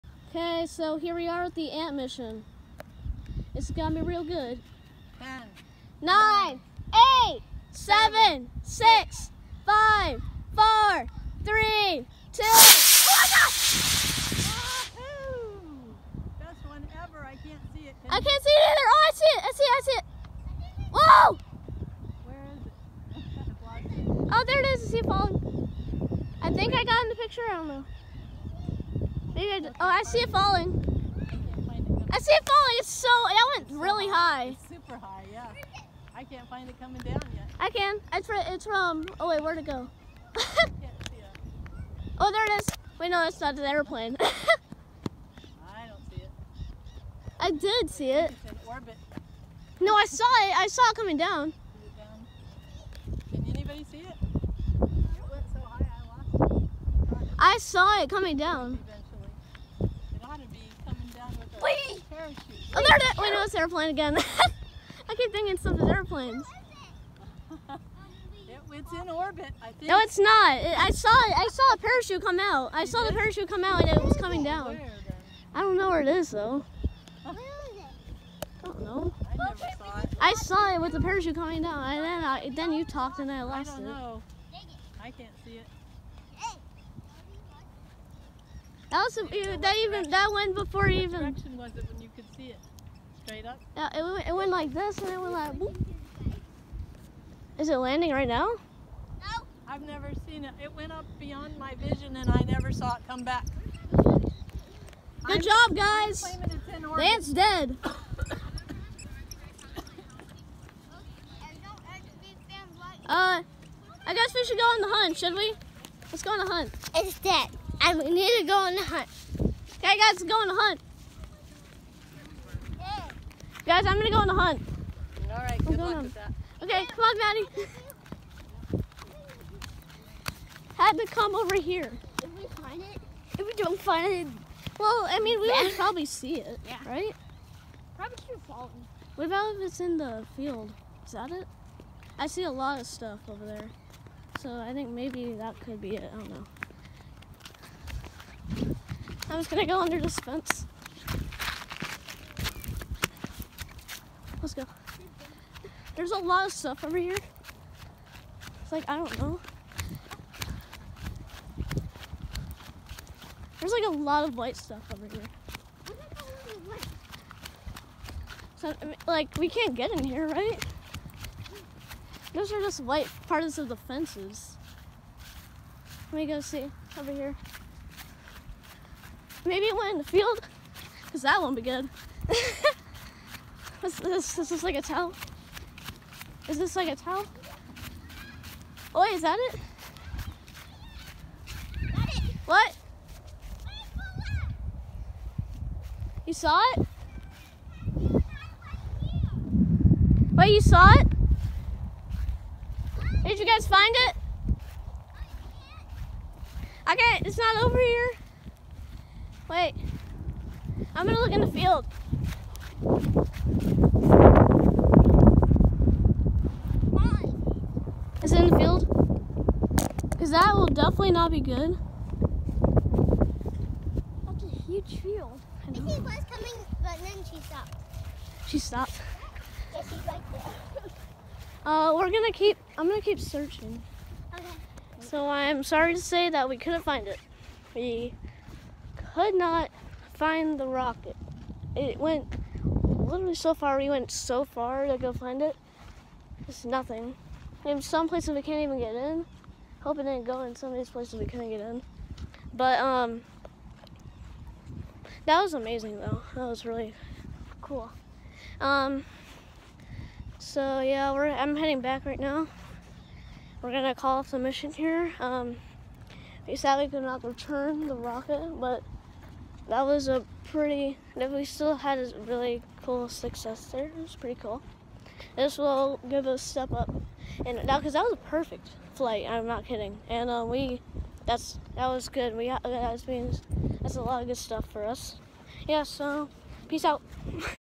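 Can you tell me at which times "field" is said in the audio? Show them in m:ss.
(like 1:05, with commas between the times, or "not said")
2:20, 3:00, 3:31, 3:38, 3:45.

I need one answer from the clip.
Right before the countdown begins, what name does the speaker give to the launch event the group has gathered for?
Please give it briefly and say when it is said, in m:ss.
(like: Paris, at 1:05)
ant mission, at 0:01.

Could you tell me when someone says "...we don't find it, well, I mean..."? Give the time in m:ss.
2:13.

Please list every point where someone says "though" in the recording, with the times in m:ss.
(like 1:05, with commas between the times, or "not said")
1:16, 4:15.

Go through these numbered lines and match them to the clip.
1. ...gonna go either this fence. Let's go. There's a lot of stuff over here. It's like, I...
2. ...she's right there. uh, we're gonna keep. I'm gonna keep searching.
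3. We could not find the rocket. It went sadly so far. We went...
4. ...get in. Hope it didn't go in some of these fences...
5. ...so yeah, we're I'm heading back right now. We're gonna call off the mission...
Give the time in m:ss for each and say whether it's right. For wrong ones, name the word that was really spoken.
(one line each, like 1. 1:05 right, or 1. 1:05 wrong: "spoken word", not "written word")
1. 2:29 wrong: "under", not "either"
2. 3:49 right
3. 3:57 wrong: "literally", not "sadly"
4. 4:08 wrong: "places", not "fences"
5. 4:20 right.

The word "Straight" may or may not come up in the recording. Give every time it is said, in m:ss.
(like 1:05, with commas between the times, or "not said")
1:33.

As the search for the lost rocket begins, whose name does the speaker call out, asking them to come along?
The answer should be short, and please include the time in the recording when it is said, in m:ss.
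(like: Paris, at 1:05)
Maddie, at 2:07.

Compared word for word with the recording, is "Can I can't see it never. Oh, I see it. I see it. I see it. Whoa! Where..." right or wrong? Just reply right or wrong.
wrong.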